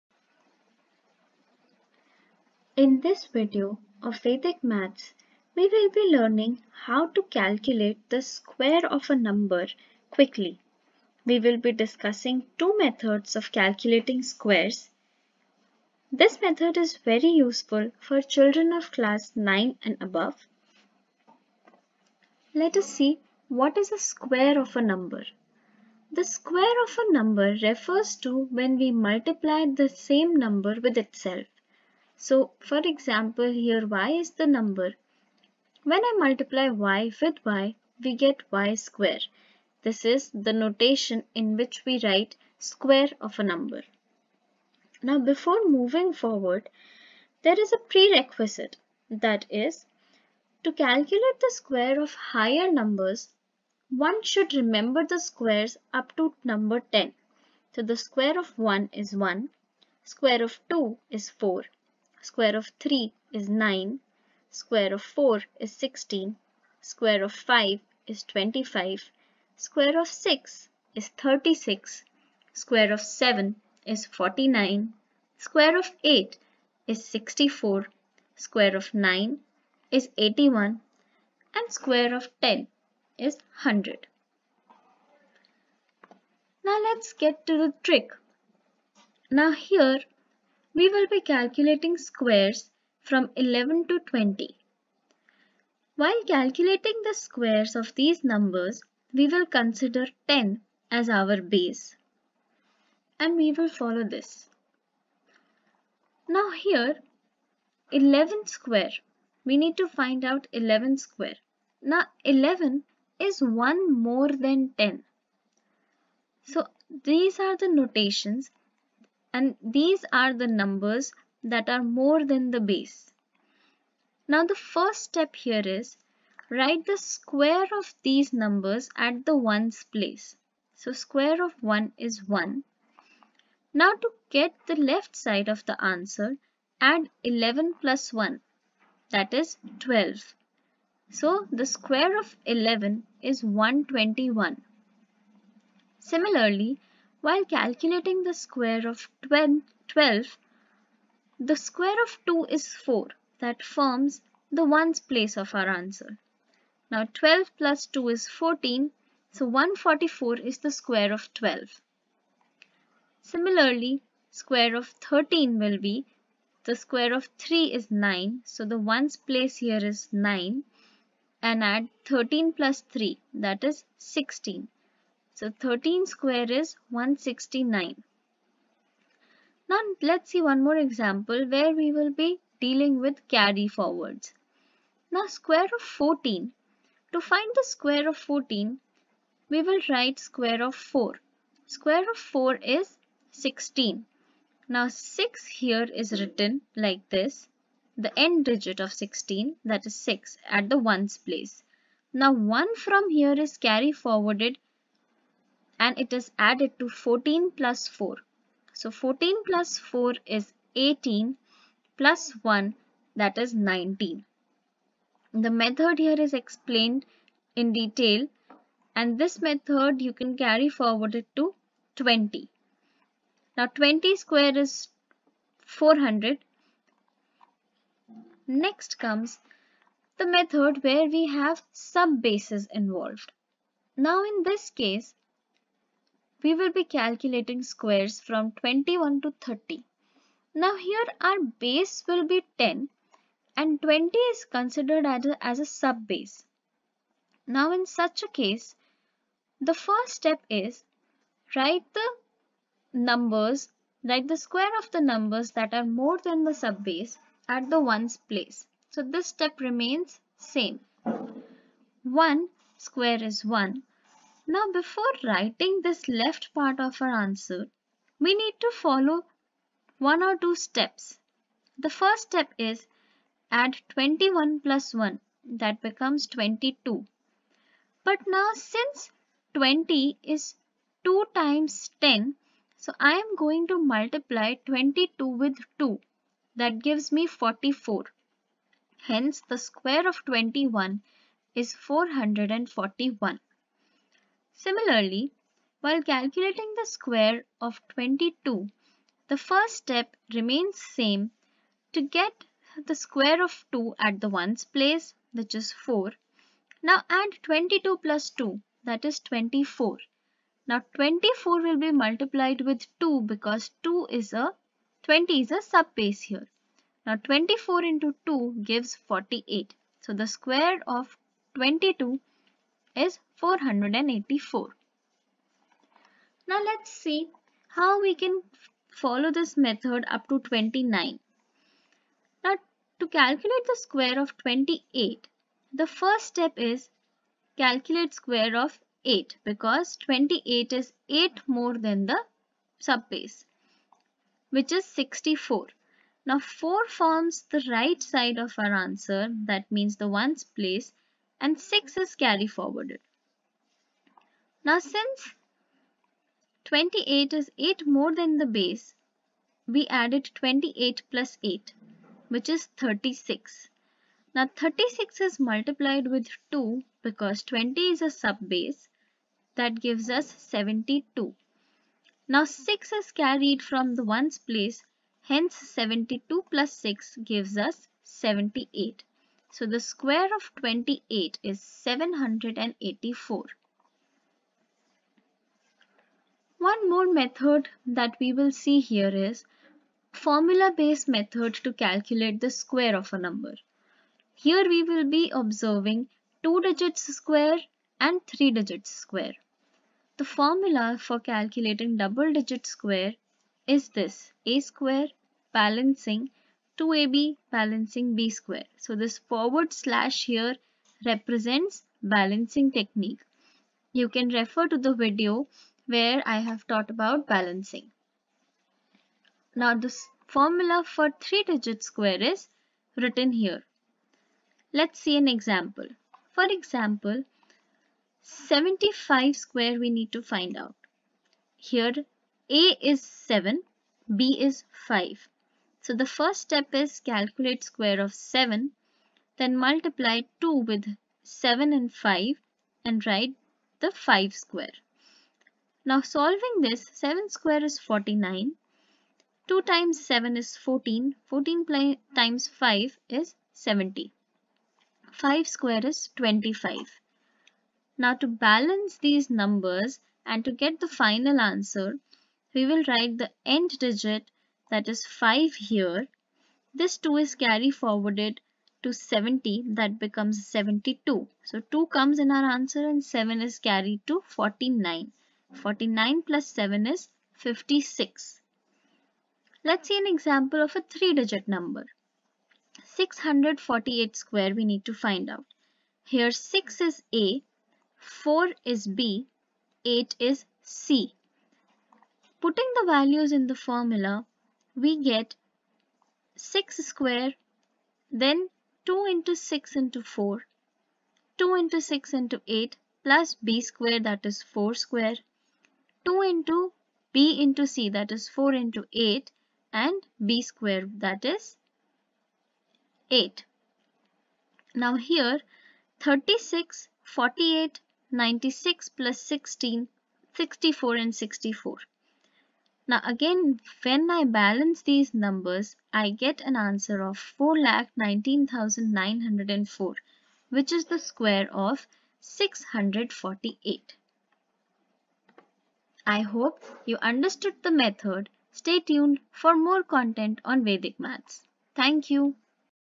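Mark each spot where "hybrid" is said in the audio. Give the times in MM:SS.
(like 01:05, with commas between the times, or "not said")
not said.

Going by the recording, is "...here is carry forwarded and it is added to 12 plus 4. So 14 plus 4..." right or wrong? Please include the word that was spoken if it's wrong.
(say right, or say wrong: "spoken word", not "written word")
wrong: "14", not "12".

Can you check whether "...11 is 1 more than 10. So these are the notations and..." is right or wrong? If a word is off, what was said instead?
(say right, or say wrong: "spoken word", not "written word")
right.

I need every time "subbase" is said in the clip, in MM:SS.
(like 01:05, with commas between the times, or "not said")
05:15, 05:42.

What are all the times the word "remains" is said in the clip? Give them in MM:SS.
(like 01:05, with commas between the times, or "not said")
04:19, 05:00.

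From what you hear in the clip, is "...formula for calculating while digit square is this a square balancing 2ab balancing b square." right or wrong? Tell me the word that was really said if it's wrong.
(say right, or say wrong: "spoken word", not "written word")
wrong: "double", not "while".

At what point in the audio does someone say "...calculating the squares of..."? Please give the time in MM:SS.
01:36.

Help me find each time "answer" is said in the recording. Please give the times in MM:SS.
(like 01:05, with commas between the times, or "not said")
02:15, 02:35, 04:27, 05:48, 07:41, 07:52.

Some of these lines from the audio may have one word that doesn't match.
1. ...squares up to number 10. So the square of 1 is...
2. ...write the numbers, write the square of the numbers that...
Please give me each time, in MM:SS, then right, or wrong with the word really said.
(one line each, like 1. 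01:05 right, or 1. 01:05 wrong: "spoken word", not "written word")
1. 00:55 right
2. 04:11 right.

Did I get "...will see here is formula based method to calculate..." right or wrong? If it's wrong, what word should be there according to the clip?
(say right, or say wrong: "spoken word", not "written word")
right.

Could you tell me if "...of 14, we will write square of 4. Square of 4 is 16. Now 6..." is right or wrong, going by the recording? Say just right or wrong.
right.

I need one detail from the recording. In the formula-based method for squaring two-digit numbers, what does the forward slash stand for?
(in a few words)
balancing technique.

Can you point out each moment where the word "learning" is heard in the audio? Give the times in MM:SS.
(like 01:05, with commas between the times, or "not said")
00:06.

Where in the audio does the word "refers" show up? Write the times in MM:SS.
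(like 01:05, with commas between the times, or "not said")
00:27, 06:54.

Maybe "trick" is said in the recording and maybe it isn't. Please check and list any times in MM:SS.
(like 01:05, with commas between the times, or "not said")
01:27.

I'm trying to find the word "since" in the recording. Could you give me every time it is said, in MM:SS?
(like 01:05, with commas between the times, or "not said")
04:38, 05:54.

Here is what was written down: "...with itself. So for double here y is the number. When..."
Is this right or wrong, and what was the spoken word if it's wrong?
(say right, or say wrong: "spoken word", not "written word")
wrong: "example", not "double".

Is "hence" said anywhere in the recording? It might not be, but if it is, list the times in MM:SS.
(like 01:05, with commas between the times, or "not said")
04:49, 06:15.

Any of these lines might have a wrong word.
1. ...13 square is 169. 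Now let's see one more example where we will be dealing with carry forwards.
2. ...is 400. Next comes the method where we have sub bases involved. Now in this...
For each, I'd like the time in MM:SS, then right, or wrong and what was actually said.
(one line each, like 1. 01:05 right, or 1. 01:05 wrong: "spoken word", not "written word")
1. 02:55 right
2. 03:44 right.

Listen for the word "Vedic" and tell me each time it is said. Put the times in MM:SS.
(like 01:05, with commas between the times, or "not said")
00:04, 09:00.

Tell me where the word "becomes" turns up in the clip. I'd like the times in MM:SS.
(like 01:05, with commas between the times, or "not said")
04:35, 07:49.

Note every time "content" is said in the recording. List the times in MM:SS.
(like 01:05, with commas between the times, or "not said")
08:59.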